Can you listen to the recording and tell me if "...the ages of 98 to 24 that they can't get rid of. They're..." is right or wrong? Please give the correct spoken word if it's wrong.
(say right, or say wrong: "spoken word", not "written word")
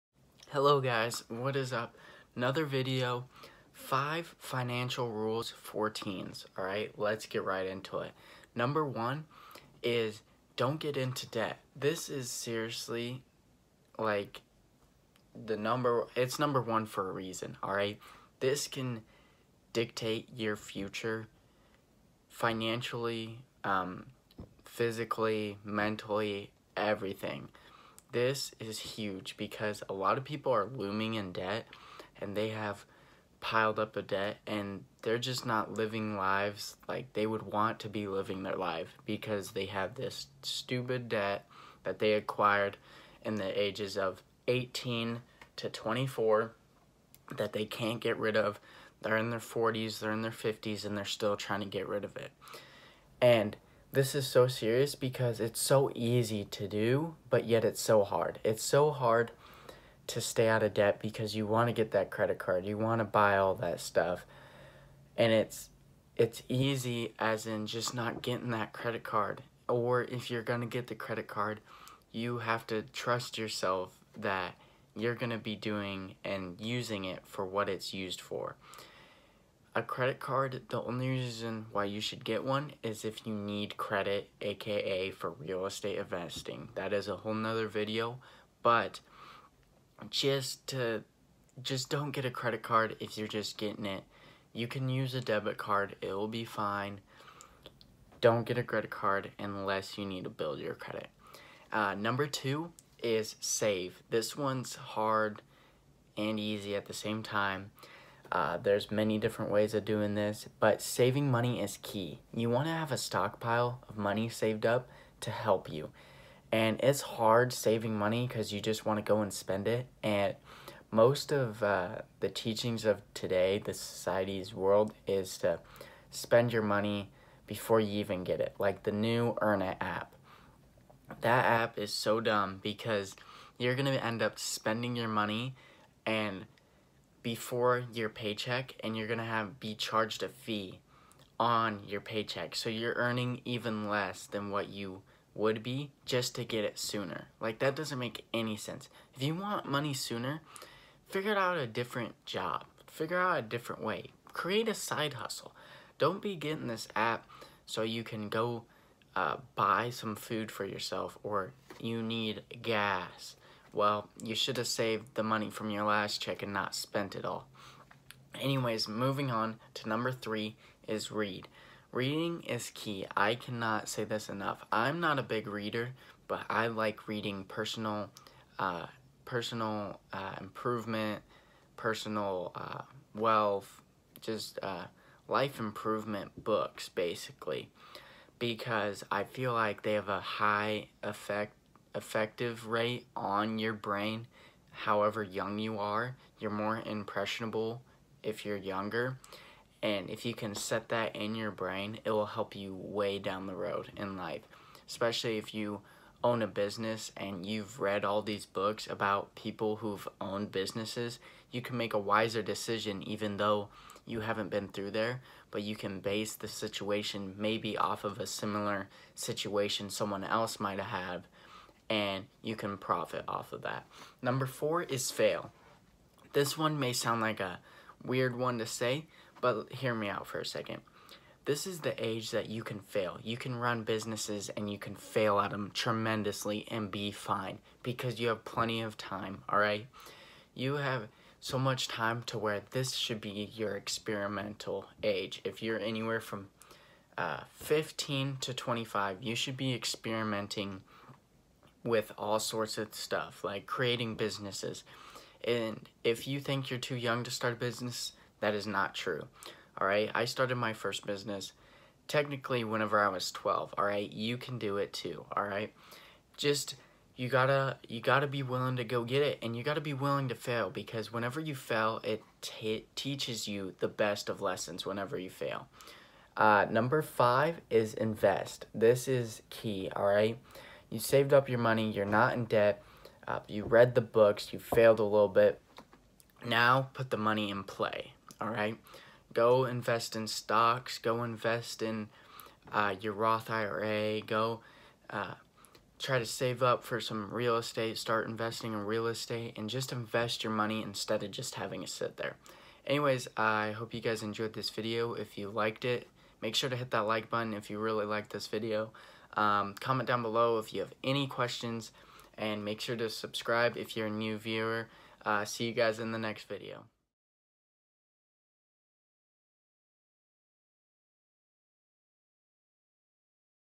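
wrong: "18", not "98".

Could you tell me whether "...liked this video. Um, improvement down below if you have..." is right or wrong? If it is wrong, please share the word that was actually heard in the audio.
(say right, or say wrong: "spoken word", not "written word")
wrong: "comment", not "improvement".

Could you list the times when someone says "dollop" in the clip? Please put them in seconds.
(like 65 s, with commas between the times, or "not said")
not said.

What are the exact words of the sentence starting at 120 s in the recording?
And most of uh, the teachings of today, the society's world, is to spend your money before you even get it.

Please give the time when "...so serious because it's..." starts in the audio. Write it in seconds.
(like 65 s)
54 s.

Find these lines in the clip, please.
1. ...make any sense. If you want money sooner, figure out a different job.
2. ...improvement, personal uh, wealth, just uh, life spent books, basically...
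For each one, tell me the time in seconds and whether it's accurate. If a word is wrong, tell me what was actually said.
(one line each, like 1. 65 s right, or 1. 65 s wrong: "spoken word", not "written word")
1. 147 s right
2. 180 s wrong: "improvement", not "spent".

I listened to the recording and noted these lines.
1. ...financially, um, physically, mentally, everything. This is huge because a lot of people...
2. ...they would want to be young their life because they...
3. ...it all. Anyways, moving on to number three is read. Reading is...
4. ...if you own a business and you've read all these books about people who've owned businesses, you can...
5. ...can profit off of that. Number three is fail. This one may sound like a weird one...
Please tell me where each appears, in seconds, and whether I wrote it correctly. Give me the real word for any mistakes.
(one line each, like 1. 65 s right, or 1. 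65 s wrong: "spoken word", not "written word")
1. 22 s right
2. 37 s wrong: "living", not "young"
3. 167 s right
4. 205 s right
5. 222 s wrong: "four", not "three".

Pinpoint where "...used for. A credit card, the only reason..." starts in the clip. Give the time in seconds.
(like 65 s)
77 s.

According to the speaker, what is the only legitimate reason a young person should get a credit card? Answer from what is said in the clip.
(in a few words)
Real estate investing.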